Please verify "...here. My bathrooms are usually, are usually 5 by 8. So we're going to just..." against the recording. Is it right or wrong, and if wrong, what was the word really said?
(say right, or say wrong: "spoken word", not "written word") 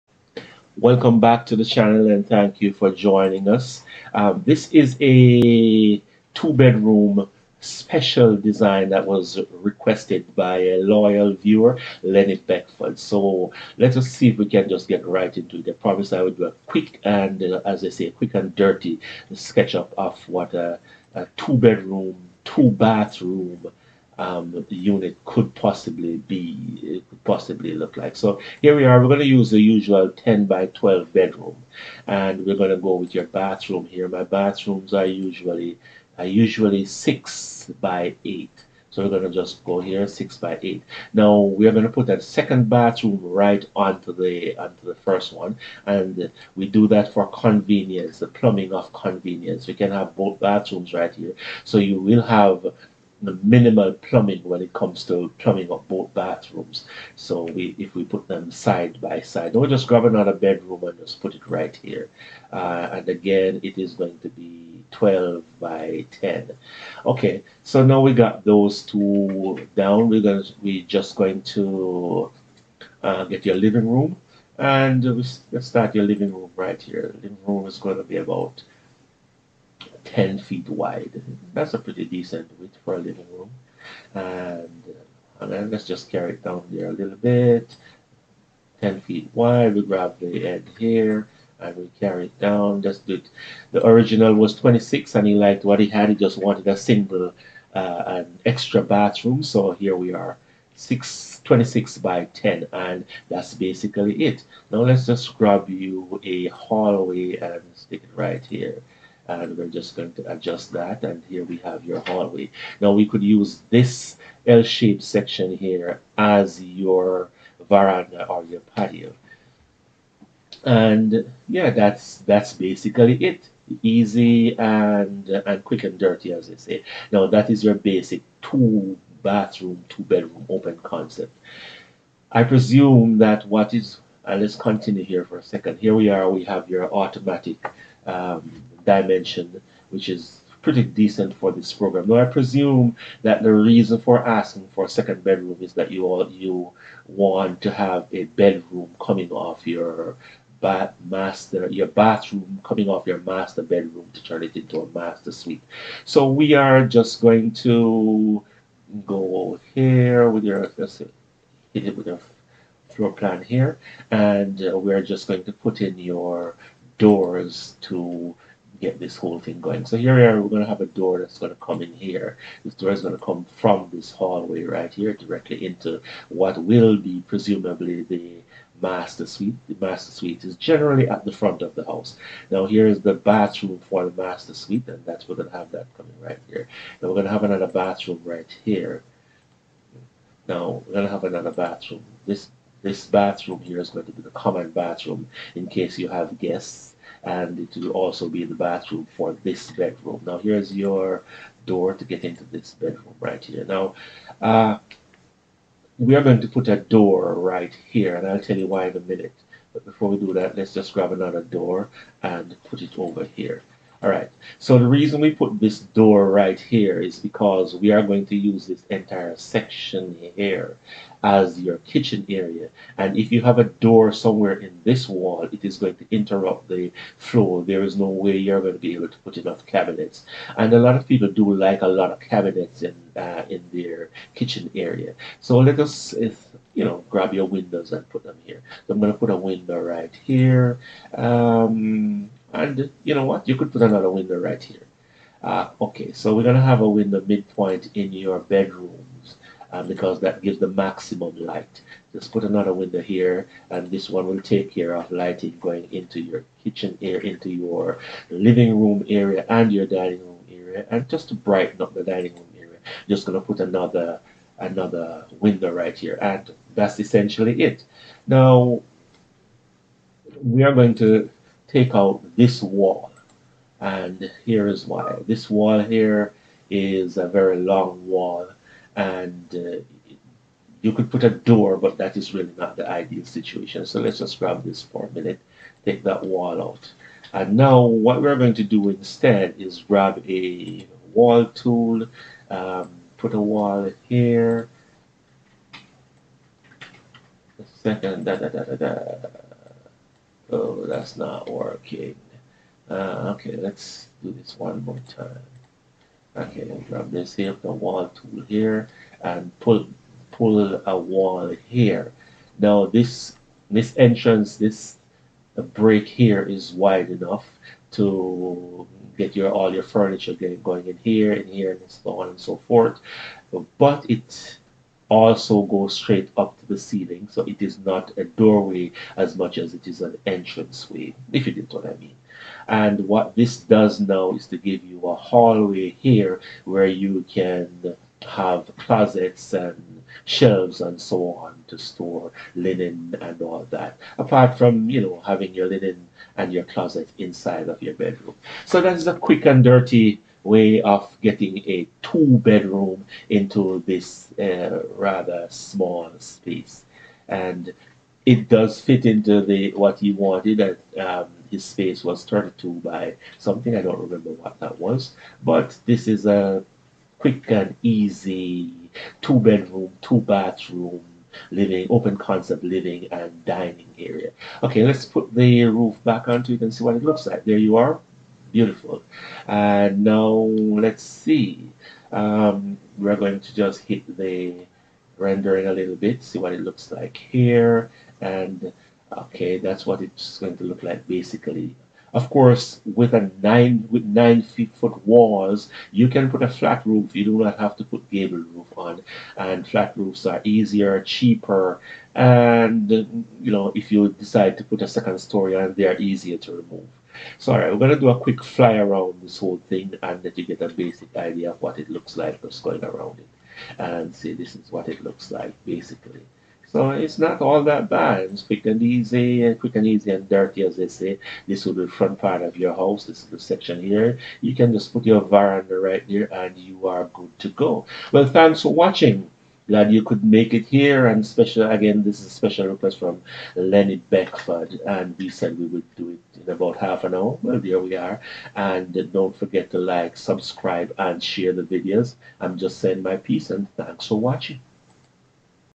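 wrong: "6", not "5".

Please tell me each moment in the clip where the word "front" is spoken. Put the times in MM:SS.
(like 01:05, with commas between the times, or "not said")
03:01, 07:01.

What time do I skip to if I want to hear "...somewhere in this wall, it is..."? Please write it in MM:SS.
03:44.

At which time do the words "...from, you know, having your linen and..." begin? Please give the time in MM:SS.
05:44.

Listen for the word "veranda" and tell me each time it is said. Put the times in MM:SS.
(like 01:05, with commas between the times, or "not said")
01:57, 07:05.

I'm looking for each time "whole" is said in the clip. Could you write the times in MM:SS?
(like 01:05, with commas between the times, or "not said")
02:49, 06:49.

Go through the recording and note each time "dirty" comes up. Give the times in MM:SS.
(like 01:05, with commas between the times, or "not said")
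00:18, 02:05, 05:49, 07:00.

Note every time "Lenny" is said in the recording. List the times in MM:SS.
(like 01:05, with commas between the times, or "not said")
00:12, 07:13.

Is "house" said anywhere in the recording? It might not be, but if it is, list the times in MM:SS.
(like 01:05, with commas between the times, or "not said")
03:01, 07:02.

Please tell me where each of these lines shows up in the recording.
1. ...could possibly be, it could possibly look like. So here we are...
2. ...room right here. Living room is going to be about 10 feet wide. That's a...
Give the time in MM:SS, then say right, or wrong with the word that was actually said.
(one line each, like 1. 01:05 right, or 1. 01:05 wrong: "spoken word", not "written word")
1. 00:25 right
2. 01:16 right.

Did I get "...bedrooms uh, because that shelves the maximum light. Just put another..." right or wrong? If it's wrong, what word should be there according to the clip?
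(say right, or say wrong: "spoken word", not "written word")
wrong: "gives", not "shelves".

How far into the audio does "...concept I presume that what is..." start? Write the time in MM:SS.
02:10.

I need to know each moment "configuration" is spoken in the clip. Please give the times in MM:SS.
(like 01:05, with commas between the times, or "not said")
not said.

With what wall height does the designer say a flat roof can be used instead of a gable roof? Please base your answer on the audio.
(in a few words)
9 feet.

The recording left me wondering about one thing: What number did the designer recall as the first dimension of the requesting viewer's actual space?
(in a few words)
32.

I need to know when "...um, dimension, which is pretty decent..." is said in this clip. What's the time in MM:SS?
02:18.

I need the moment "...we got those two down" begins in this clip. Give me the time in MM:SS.
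01:08.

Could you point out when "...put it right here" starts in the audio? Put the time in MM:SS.
01:01.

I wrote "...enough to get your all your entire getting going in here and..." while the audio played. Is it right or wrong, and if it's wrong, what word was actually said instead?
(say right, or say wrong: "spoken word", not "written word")
wrong: "furniture", not "entire".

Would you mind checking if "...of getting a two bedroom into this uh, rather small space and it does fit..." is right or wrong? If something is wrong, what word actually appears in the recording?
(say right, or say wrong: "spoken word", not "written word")
right.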